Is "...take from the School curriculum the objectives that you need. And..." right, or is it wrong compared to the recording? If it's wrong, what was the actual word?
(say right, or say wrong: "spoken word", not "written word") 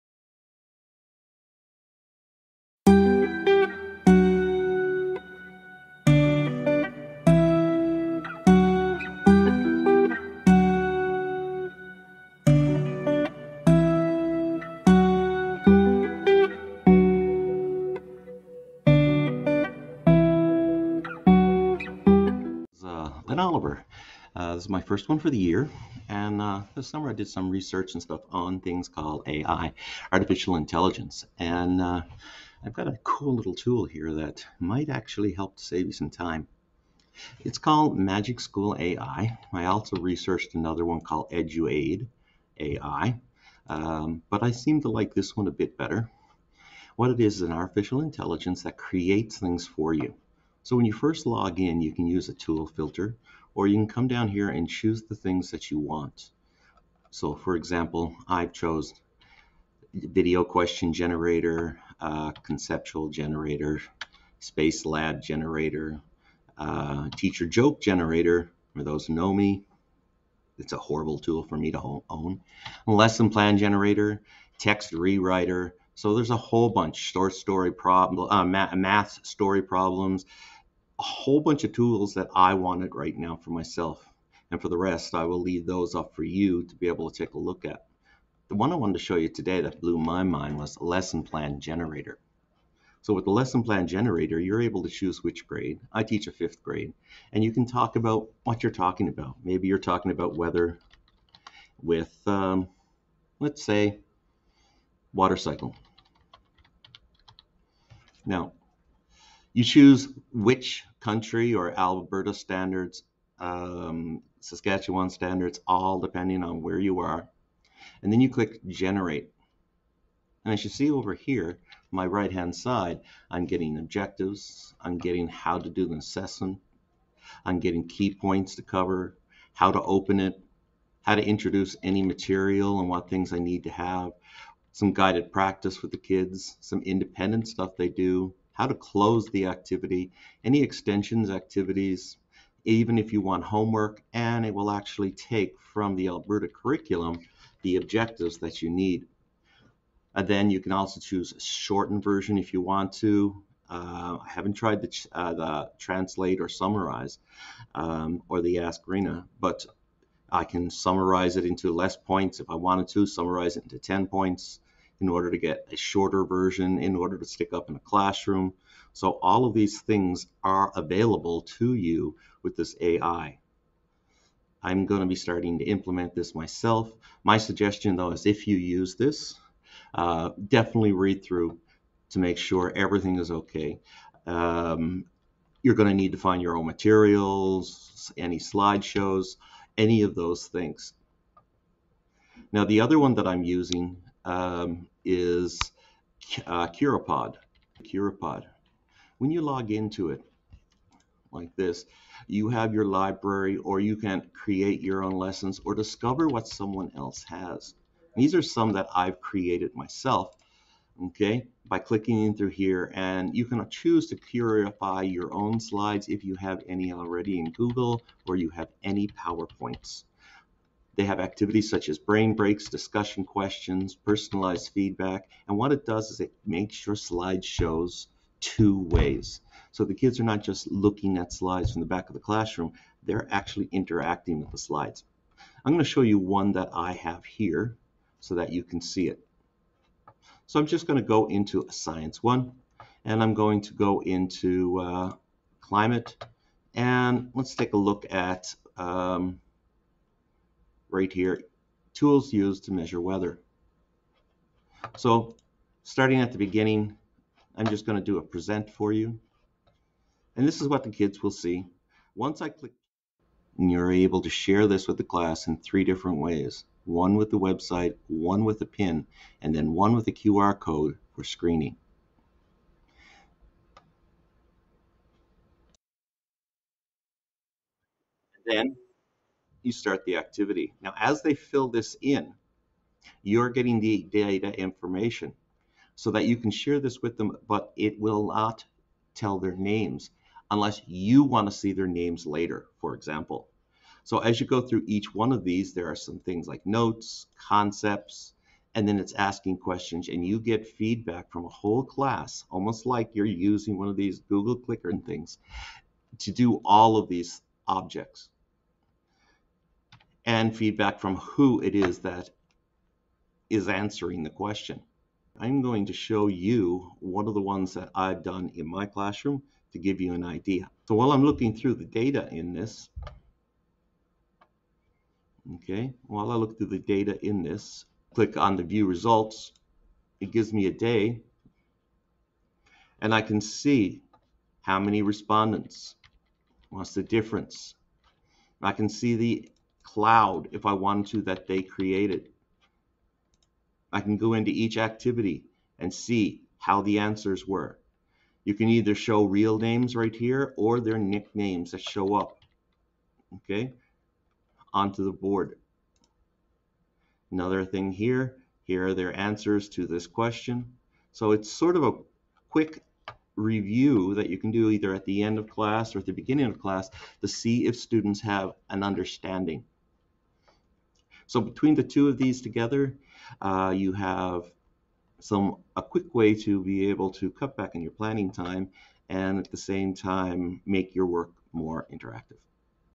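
wrong: "Alberta", not "School".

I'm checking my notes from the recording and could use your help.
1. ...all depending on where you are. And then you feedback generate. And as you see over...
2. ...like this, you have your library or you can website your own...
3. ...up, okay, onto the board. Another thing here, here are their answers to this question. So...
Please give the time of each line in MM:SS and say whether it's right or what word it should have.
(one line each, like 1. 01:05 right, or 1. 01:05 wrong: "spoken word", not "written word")
1. 01:55 wrong: "click", not "feedback"
2. 03:21 wrong: "create", not "website"
3. 05:52 right.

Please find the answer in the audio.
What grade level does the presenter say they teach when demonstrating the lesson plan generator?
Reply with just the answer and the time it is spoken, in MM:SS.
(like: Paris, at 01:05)
Fifth grade, at 01:36.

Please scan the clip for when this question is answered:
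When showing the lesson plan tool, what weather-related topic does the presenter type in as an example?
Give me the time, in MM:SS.
01:45.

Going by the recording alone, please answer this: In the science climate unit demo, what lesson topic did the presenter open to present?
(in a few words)
Tools used to measure weather.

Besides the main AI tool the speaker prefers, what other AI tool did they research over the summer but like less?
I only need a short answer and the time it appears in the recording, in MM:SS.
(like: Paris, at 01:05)
Eduaide AI, at 00:41.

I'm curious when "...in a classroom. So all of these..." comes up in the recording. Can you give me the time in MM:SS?
02:47.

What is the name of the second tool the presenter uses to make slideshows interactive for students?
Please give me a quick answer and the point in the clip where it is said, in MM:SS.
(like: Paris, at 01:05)
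Curipod, at 03:16.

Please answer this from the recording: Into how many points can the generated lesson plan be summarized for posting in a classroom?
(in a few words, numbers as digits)
10.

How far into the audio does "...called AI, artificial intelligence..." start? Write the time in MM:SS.
00:28.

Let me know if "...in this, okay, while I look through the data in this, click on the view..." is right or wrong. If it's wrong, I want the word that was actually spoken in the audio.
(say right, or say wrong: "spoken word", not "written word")
right.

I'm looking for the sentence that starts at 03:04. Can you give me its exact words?
Um, you're going to need to find your own materials, any slideshows, any of those things.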